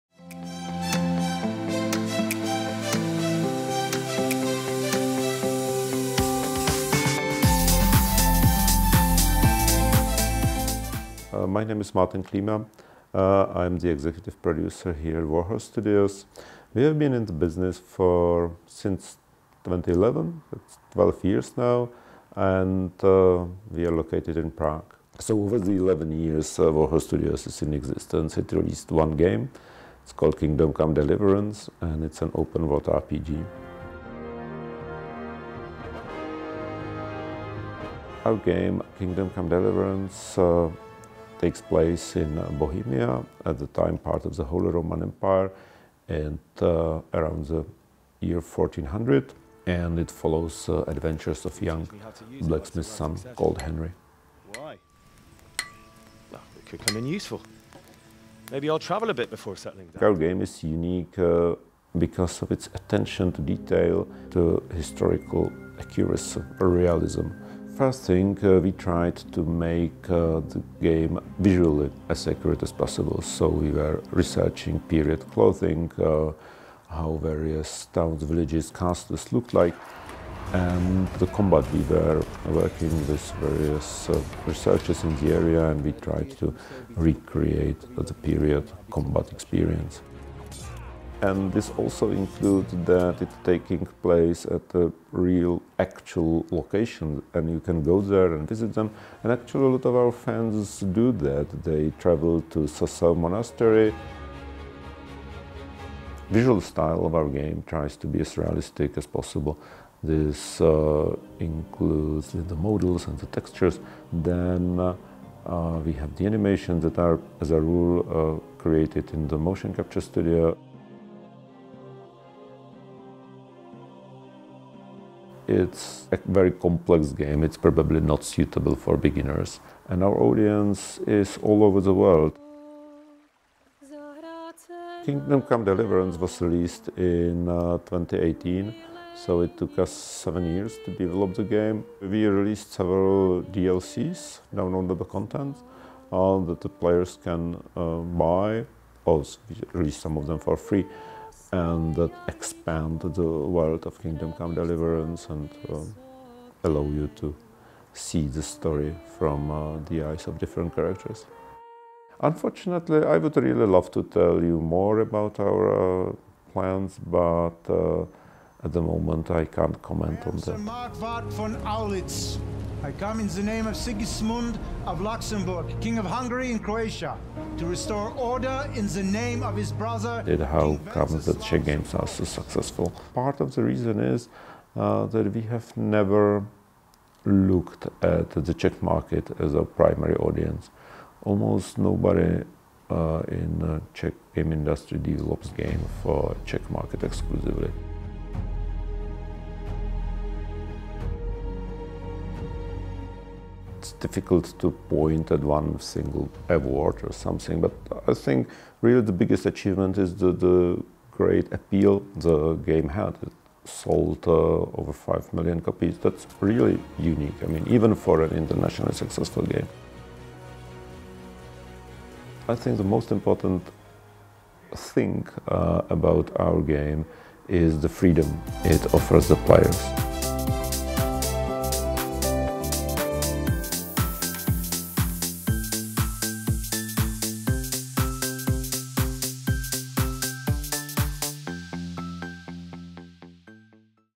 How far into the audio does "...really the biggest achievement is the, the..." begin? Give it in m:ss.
3:28.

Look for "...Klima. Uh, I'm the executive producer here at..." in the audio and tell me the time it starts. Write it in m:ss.
0:12.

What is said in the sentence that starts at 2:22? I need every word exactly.
We released several DLCs, downloadable content, uh, that the players can uh, buy.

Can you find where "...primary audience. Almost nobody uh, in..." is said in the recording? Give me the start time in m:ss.
3:09.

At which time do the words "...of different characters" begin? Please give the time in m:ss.
2:40.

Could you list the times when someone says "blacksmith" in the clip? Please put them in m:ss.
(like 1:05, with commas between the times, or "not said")
0:52.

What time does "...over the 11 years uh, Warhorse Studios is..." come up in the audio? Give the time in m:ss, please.
0:25.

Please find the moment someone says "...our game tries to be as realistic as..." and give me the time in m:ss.
1:47.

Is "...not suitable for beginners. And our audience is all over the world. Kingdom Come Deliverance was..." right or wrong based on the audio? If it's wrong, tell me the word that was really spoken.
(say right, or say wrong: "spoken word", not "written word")
right.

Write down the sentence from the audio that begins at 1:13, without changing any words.
So we were researching period clothing, uh, how various towns, villages, castles looked like.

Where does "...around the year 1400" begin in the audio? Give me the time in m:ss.
0:47.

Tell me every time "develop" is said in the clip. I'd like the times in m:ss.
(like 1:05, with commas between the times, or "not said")
2:20, 3:14.